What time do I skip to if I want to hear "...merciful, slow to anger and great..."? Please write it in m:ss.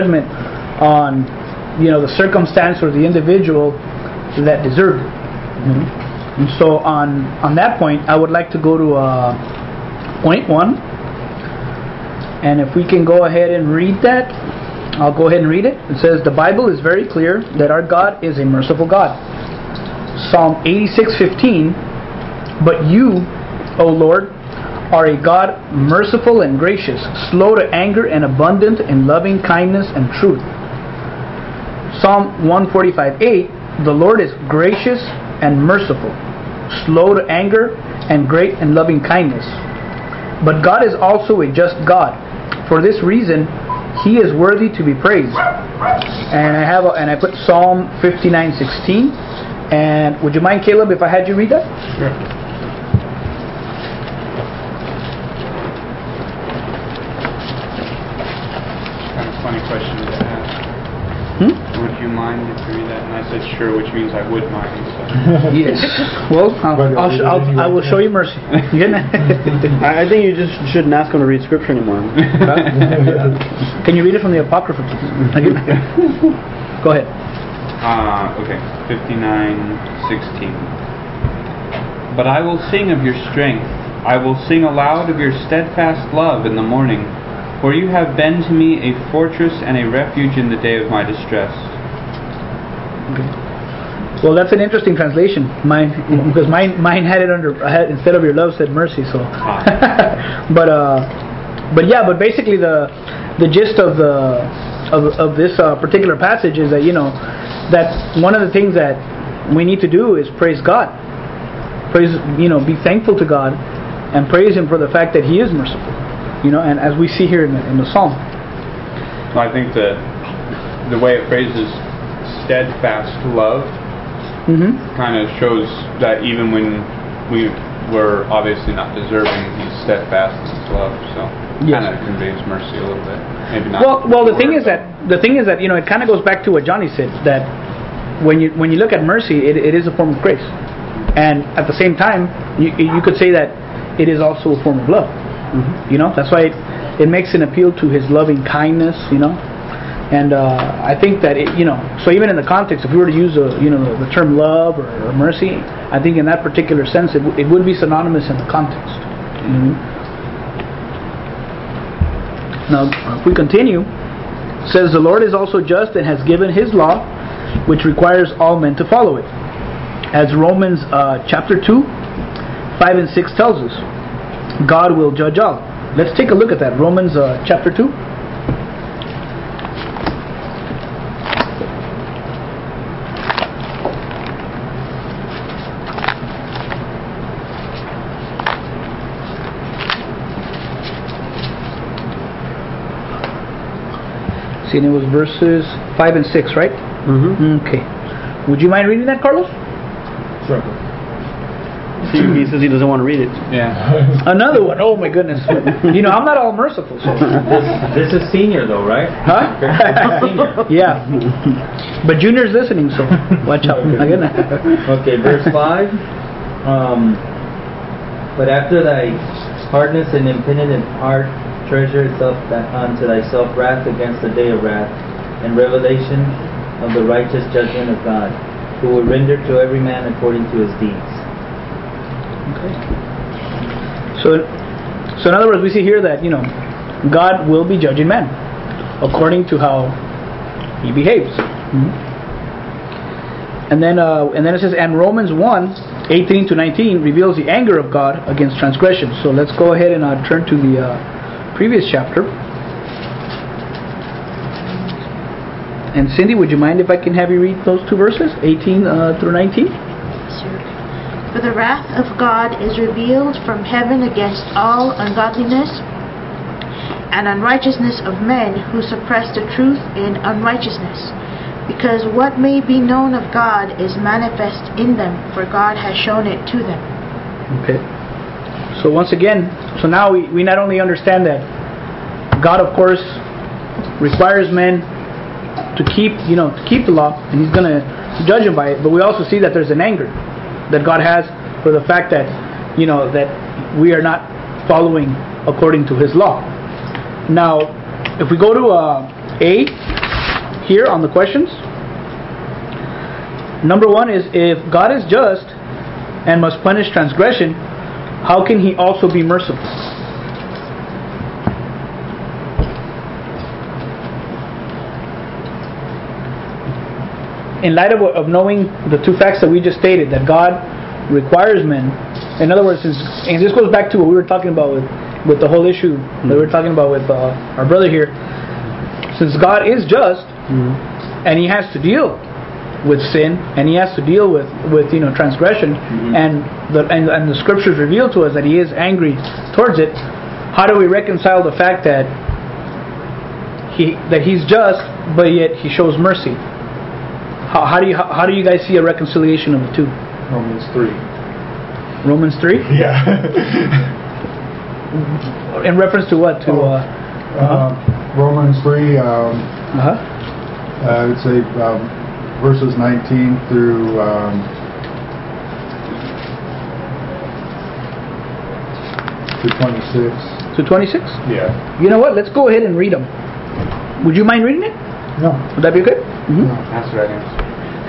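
0:35.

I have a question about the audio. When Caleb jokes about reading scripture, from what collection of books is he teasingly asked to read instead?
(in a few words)
the Apocrypha.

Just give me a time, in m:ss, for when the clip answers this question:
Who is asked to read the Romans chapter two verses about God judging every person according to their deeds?
3:19.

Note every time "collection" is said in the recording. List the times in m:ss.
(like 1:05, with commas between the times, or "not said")
not said.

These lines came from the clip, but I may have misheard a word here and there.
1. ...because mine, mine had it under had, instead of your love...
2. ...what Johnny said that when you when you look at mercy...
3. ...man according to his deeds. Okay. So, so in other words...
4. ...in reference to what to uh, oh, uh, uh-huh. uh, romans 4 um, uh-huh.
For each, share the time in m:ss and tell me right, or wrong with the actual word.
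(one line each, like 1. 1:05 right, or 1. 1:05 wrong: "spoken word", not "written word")
1. 1:36 right
2. 2:16 right
3. 3:49 right
4. 5:55 wrong: "3", not "4".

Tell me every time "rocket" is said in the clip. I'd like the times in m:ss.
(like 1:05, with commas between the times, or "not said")
not said.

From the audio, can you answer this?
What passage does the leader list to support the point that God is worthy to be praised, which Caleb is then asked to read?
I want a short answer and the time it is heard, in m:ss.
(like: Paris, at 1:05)
Psalm 59:16, at 0:47.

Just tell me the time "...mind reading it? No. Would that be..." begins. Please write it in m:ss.
6:14.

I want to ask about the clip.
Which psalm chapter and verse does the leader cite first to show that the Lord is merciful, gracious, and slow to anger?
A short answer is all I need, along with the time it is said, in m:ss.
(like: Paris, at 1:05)
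Psalm 86:15, at 0:20.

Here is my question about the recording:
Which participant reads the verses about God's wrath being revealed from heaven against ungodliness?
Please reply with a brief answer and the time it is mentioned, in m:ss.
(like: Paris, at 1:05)
Cindy, at 4:16.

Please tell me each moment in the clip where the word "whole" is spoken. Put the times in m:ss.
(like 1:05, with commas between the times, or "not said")
5:25.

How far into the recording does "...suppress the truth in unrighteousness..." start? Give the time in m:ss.
4:28.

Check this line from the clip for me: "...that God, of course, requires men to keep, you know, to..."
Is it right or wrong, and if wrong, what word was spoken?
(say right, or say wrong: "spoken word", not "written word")
right.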